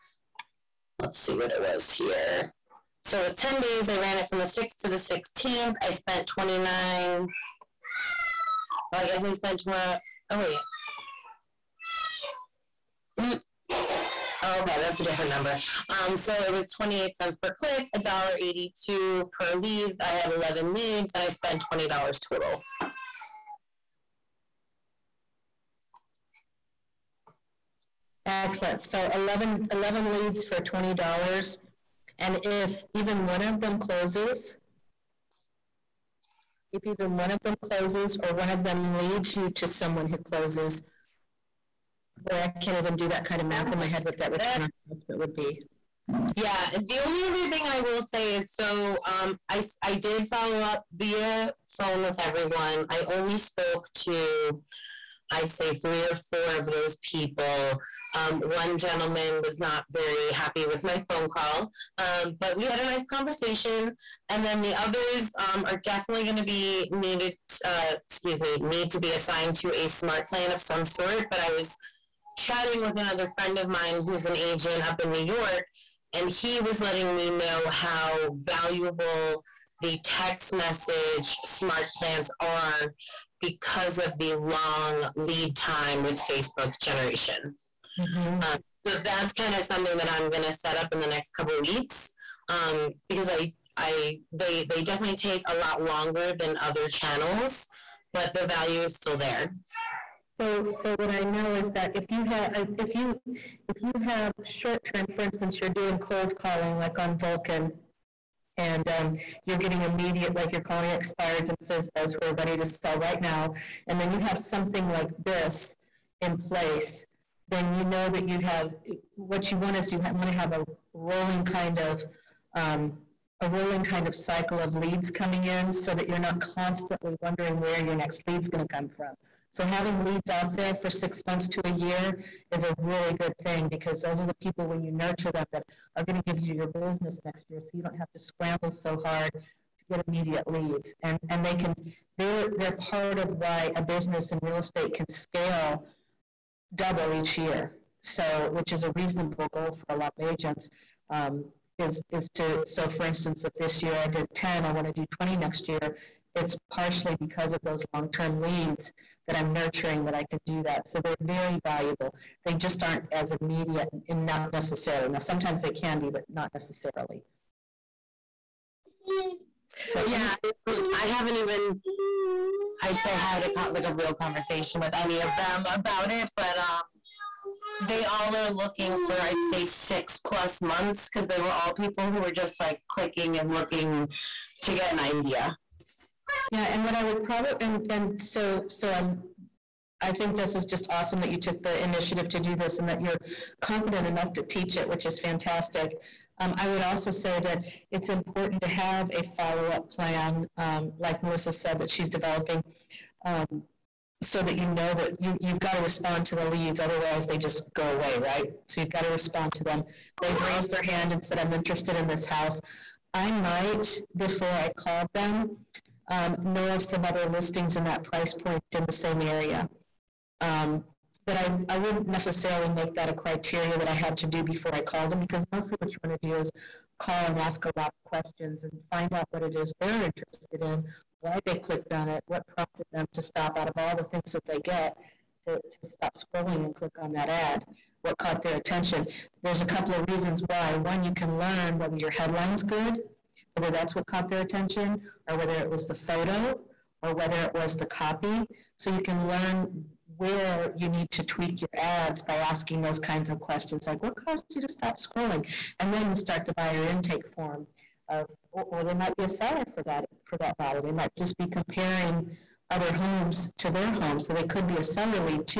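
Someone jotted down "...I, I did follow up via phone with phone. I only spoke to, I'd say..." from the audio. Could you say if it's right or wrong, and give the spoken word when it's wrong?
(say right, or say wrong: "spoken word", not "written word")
wrong: "everyone", not "phone".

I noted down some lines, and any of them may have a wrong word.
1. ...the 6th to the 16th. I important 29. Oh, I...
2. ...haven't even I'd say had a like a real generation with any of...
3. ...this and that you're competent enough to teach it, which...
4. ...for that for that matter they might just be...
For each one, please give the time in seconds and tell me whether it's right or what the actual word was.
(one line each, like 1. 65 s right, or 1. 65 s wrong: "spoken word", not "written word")
1. 4 s wrong: "spent", not "important"
2. 171 s wrong: "conversation", not "generation"
3. 192 s right
4. 259 s right.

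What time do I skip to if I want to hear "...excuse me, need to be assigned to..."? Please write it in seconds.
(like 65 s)
68 s.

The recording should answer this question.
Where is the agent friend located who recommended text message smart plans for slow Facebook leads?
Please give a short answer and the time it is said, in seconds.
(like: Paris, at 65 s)
New York, at 75 s.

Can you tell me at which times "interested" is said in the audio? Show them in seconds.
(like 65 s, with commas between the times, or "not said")
211 s, 230 s.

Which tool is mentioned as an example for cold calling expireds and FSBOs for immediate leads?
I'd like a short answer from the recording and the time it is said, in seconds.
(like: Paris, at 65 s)
Vulcan, at 107 s.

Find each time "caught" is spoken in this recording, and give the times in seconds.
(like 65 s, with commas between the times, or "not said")
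238 s, 244 s.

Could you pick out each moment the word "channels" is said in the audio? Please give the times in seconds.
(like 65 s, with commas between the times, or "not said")
96 s.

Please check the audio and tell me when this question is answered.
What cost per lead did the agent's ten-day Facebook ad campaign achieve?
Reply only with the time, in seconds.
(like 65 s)
17 s.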